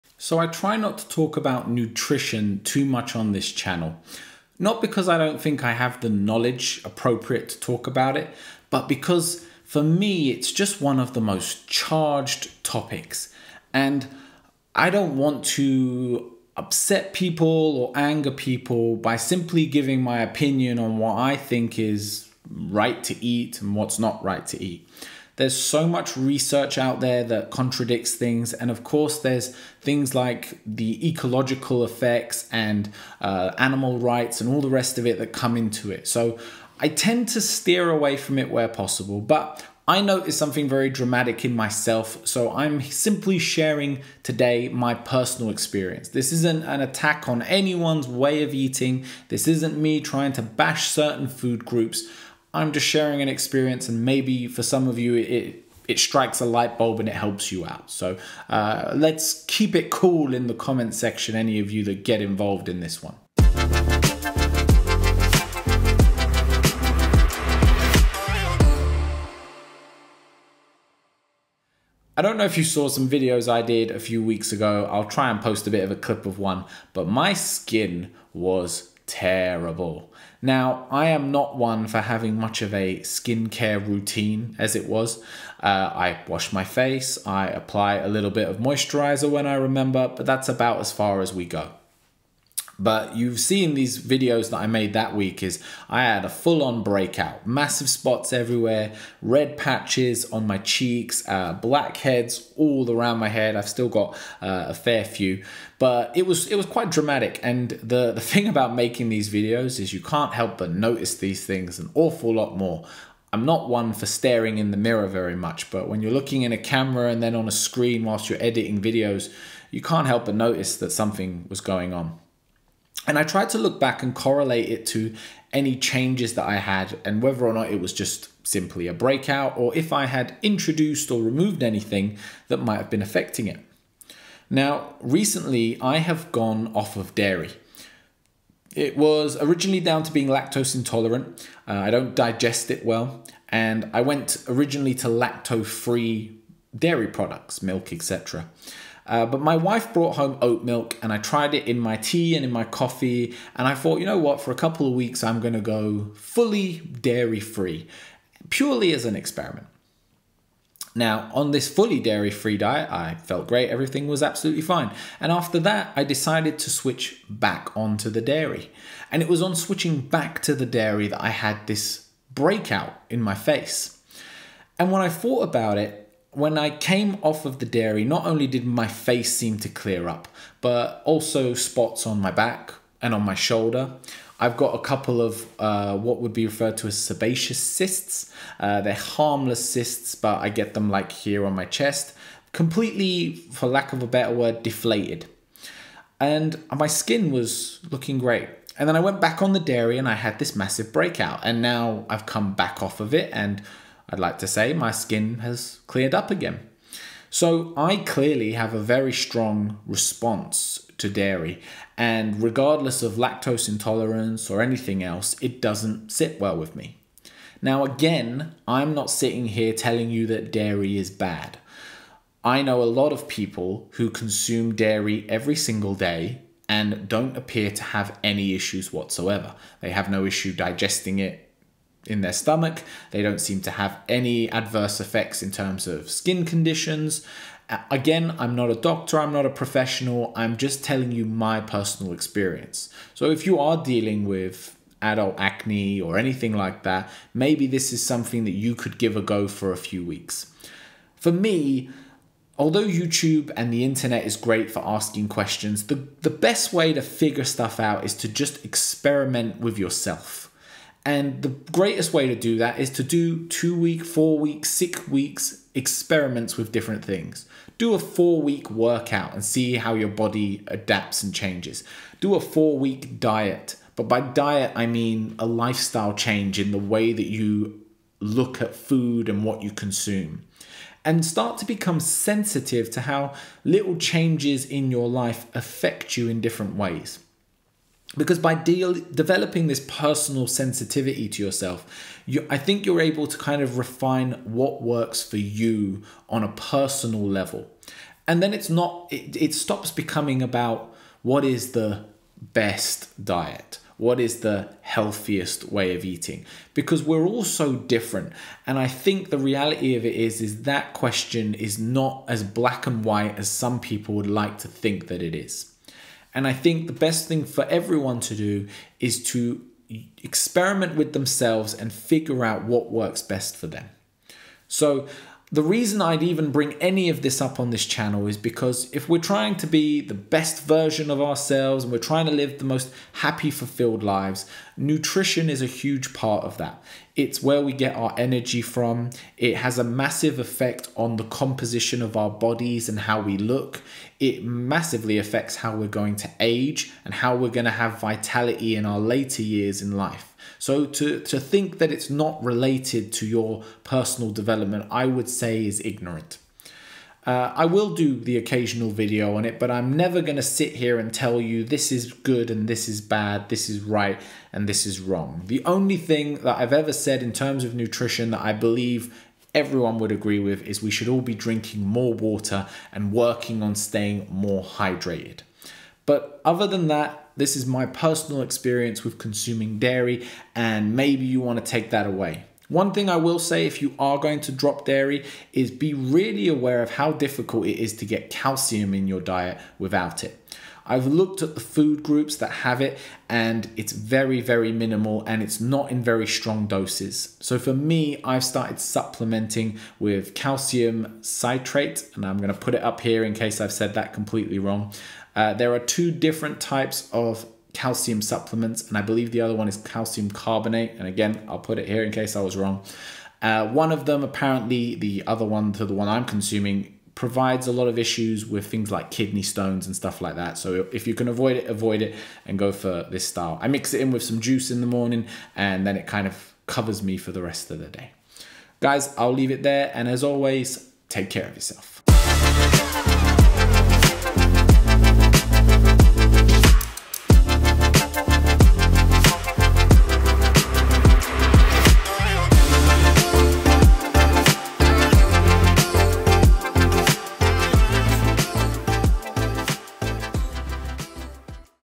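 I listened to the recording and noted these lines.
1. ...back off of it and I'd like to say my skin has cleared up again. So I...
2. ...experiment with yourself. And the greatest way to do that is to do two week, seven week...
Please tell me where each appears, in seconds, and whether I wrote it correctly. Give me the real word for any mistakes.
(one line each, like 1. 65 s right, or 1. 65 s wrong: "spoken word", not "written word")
1. 202 s right
2. 258 s wrong: "four", not "seven".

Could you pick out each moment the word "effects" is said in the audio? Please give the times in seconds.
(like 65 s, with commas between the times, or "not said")
31 s, 234 s, 340 s.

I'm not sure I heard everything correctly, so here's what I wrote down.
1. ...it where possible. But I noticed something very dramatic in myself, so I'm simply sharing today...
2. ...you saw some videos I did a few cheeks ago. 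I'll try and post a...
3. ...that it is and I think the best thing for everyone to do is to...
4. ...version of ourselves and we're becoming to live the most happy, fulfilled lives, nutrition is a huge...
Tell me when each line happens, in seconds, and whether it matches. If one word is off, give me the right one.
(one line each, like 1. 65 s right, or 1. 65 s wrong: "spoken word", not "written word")
1. 38 s right
2. 72 s wrong: "weeks", not "cheeks"
3. 315 s right
4. 330 s wrong: "trying", not "becoming".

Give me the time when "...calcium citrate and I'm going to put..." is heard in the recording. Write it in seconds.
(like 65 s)
400 s.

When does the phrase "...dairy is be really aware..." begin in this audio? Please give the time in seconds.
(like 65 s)
384 s.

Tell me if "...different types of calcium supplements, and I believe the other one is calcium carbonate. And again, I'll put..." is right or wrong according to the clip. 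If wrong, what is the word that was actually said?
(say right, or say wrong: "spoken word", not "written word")
right.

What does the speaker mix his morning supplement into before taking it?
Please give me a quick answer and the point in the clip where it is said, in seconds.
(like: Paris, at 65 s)
juice, at 424 s.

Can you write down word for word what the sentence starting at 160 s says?
Now, on this fully dairy free diet, I felt great.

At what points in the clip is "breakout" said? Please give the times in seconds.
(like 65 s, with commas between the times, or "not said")
96 s, 128 s, 172 s, 200 s.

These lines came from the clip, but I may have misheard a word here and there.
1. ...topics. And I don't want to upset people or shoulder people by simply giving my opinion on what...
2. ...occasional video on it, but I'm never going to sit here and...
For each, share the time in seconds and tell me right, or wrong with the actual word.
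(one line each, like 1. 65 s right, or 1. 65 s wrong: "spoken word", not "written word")
1. 12 s wrong: "anger", not "shoulder"
2. 358 s right.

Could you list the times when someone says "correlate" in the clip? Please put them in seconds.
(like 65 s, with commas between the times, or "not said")
124 s.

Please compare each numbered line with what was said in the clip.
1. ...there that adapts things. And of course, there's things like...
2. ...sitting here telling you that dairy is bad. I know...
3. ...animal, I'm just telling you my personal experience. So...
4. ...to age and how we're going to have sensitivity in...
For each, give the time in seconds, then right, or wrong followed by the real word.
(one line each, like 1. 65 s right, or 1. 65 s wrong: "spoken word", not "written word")
1. 26 s wrong: "contradicts", not "adapts"
2. 219 s right
3. 239 s wrong: "professional", not "animal"
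4. 346 s wrong: "vitality", not "sensitivity".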